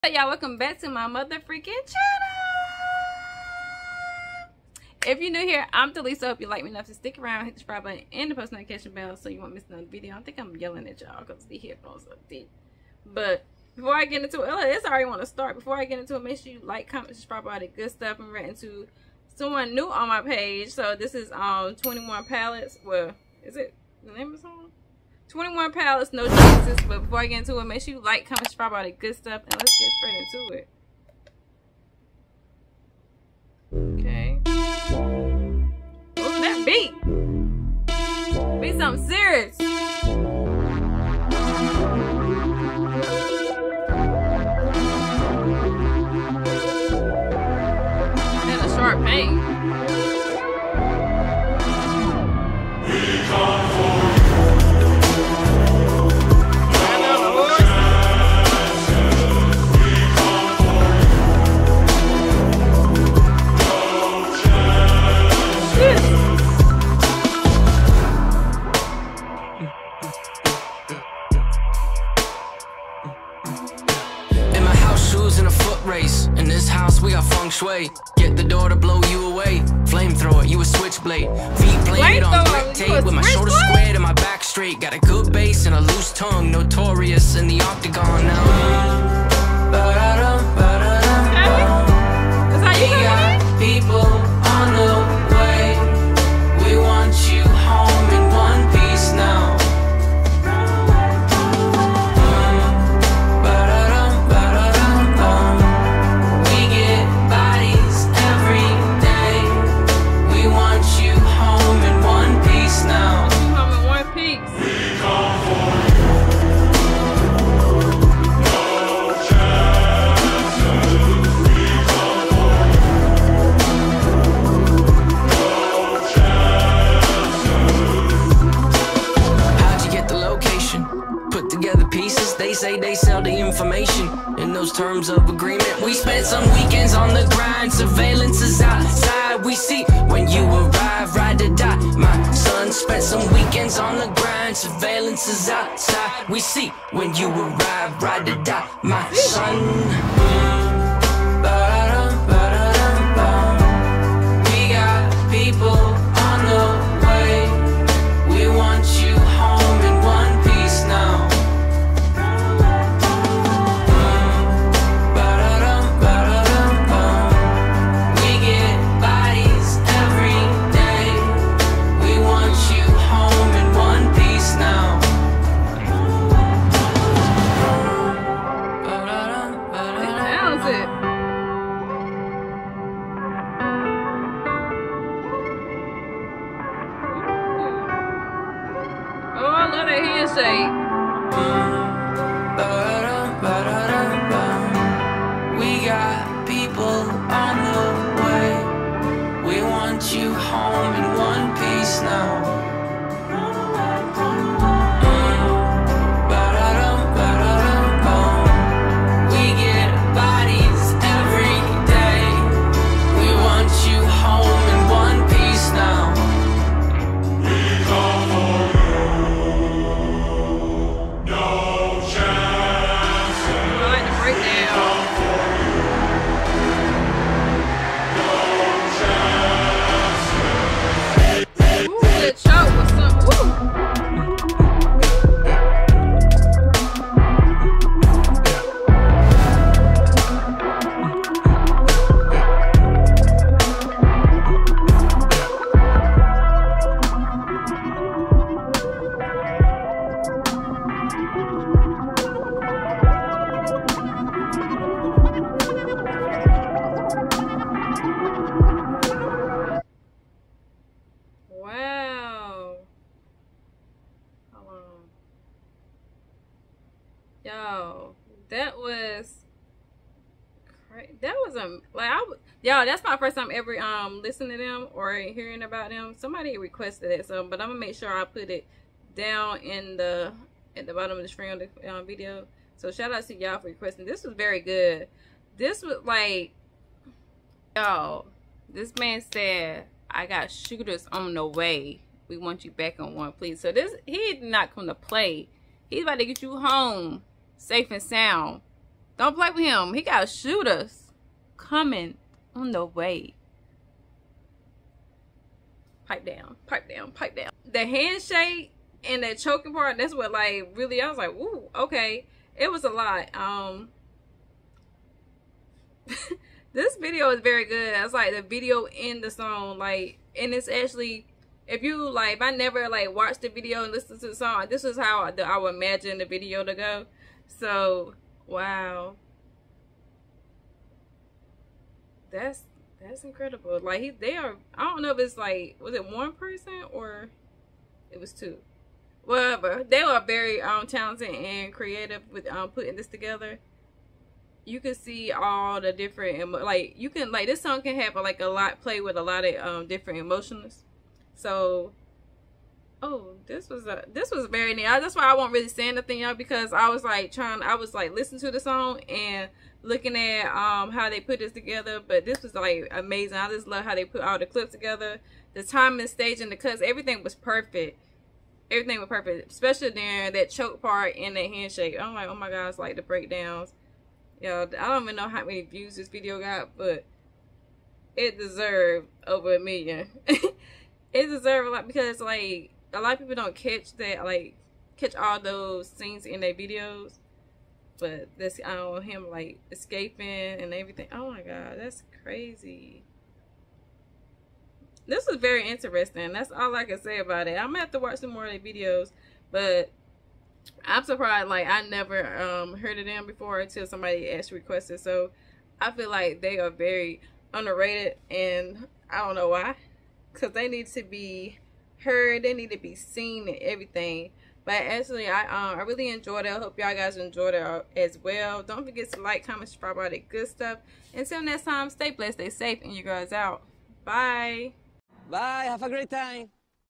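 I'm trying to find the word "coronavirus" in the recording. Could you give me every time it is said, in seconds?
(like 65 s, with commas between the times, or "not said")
not said.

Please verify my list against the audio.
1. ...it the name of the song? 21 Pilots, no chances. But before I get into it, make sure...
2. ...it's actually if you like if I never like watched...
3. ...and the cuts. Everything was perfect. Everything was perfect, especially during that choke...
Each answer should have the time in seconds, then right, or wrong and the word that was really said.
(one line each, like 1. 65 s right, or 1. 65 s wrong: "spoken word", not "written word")
1. 23 s right
2. 320 s right
3. 366 s right.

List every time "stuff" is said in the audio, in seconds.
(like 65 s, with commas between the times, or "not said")
17 s, 29 s, 420 s.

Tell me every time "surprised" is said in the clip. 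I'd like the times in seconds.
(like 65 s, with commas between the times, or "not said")
401 s.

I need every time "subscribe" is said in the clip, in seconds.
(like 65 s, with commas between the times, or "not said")
7 s, 17 s, 28 s, 419 s.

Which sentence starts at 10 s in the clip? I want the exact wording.
I think I'm yelling at y'all because the headphones are deep.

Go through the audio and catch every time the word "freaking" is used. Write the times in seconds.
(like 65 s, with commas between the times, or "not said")
1 s.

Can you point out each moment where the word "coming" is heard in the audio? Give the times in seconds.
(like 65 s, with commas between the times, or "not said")
301 s.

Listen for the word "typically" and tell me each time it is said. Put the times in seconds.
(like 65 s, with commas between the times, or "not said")
not said.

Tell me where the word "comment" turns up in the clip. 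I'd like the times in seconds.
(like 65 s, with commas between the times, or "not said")
16 s, 28 s, 419 s.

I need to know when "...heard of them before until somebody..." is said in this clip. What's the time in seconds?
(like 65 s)
402 s.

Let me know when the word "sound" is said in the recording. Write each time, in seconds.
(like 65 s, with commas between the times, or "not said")
298 s.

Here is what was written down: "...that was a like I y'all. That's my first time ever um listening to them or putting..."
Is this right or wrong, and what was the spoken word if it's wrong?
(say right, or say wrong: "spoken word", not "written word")
wrong: "hearing", not "putting".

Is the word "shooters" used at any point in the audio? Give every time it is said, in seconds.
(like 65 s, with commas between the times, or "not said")
290 s, 300 s.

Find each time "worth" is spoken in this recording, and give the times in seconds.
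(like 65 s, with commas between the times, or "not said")
not said.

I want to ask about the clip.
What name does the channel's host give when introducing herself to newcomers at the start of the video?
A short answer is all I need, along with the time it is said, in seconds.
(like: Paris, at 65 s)
Dalisa, at 5 s.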